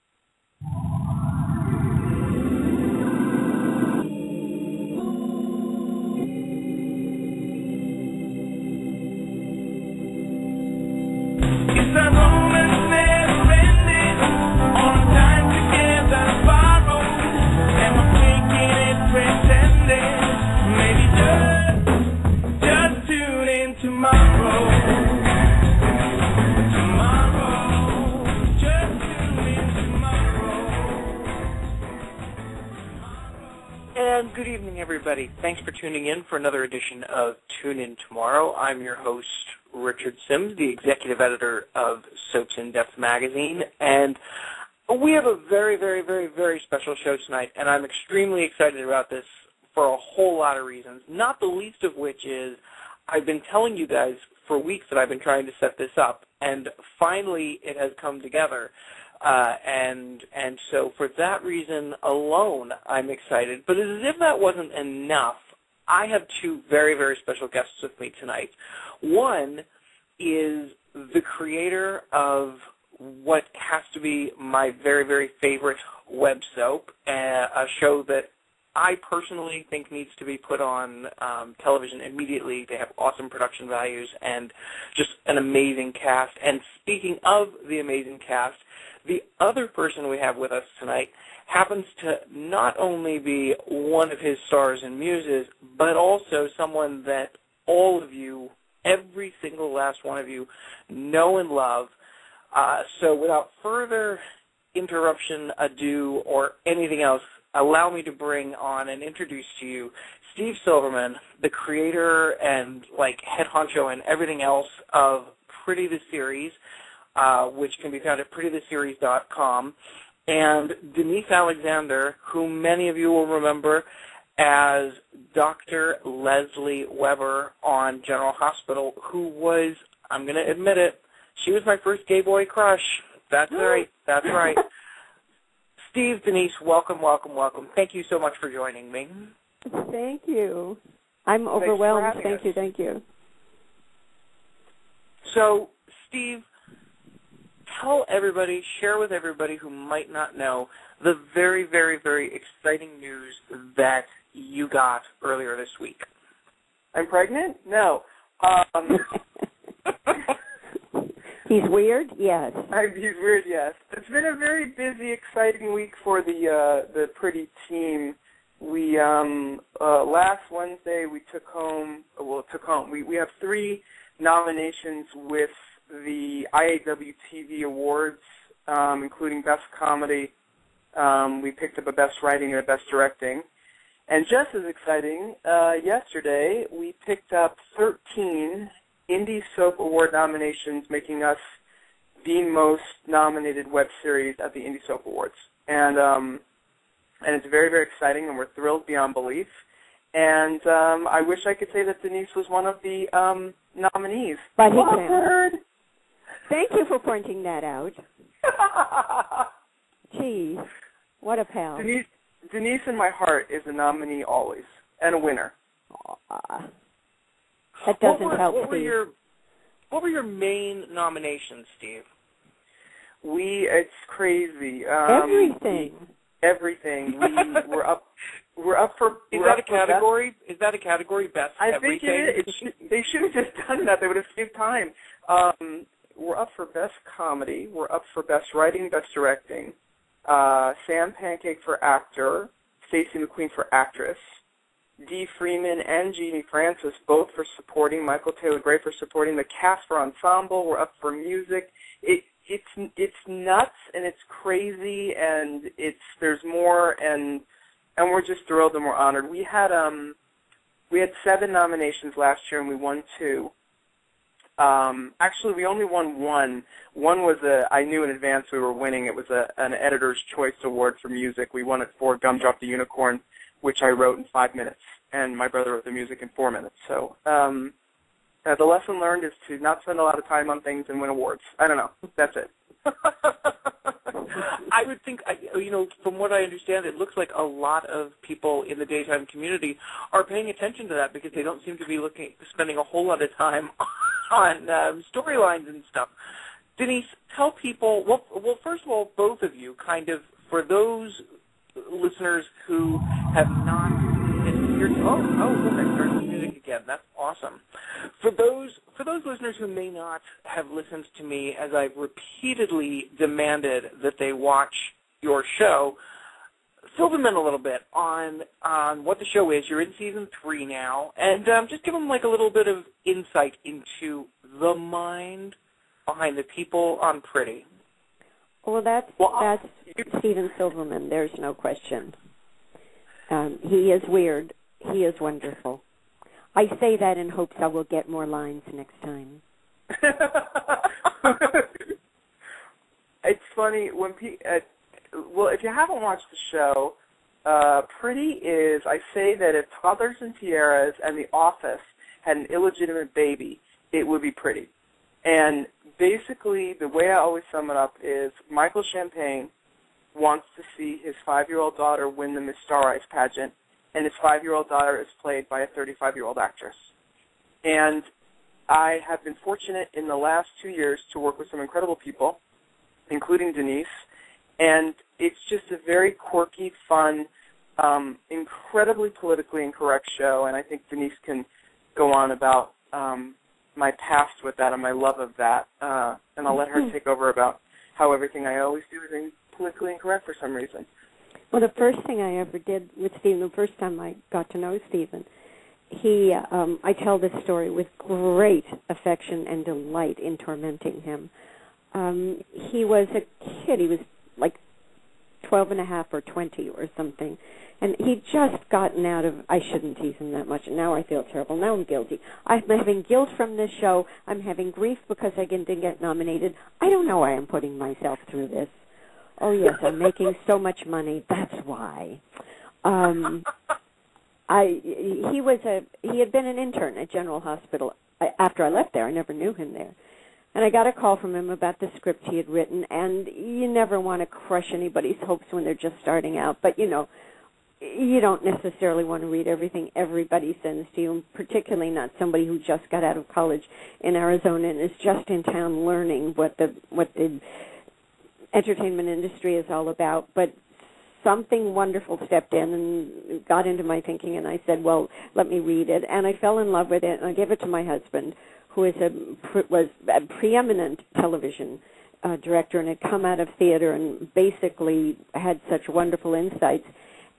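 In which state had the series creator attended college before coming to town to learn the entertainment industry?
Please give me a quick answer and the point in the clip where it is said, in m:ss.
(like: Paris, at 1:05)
Arizona, at 7:24.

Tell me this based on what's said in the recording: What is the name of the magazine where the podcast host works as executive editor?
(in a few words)
Soaps in Depth.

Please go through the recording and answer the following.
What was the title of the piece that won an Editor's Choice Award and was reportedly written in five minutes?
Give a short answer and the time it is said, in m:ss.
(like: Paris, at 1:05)
Gumdrop the Unicorn, at 4:32.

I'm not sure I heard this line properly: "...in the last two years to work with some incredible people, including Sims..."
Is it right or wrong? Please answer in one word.
wrong.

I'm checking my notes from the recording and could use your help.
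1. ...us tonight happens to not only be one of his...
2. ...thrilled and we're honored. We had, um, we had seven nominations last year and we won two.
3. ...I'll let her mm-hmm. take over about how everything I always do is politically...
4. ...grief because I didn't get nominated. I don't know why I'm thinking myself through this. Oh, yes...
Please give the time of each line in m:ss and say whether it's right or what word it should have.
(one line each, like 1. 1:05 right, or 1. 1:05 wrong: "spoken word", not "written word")
1. 1:30 right
2. 4:18 right
3. 6:26 right
4. 6:54 wrong: "putting", not "thinking".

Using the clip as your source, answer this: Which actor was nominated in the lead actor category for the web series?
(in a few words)
Sam Pancake.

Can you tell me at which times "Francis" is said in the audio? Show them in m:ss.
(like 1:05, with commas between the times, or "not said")
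4:06.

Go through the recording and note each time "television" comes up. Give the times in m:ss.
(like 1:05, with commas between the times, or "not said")
1:21, 7:41.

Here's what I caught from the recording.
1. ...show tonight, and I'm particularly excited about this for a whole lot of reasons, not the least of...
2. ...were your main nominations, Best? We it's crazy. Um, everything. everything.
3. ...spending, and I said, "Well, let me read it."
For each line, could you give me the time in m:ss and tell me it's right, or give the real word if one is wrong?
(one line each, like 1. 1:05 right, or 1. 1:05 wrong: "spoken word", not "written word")
1. 0:47 wrong: "extremely", not "particularly"
2. 3:40 wrong: "Steve", not "Best"
3. 7:34 wrong: "thinking", not "spending".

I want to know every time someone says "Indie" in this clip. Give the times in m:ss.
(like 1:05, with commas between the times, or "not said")
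3:09, 3:14.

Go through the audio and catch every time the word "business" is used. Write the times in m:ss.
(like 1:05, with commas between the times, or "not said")
not said.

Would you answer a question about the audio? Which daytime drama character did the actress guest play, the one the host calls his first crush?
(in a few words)
Dr. Lesley Webber.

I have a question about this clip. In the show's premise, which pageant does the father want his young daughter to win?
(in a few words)
Miss Star Eyes.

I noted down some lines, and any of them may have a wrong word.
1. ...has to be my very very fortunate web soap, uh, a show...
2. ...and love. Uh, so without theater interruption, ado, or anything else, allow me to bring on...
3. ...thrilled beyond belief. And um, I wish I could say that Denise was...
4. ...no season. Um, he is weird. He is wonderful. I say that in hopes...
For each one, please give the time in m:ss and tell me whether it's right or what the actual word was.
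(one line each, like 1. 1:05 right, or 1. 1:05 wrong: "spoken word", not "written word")
1. 1:13 wrong: "favorite", not "fortunate"
2. 1:41 wrong: "further", not "theater"
3. 3:18 right
4. 5:31 wrong: "question", not "season".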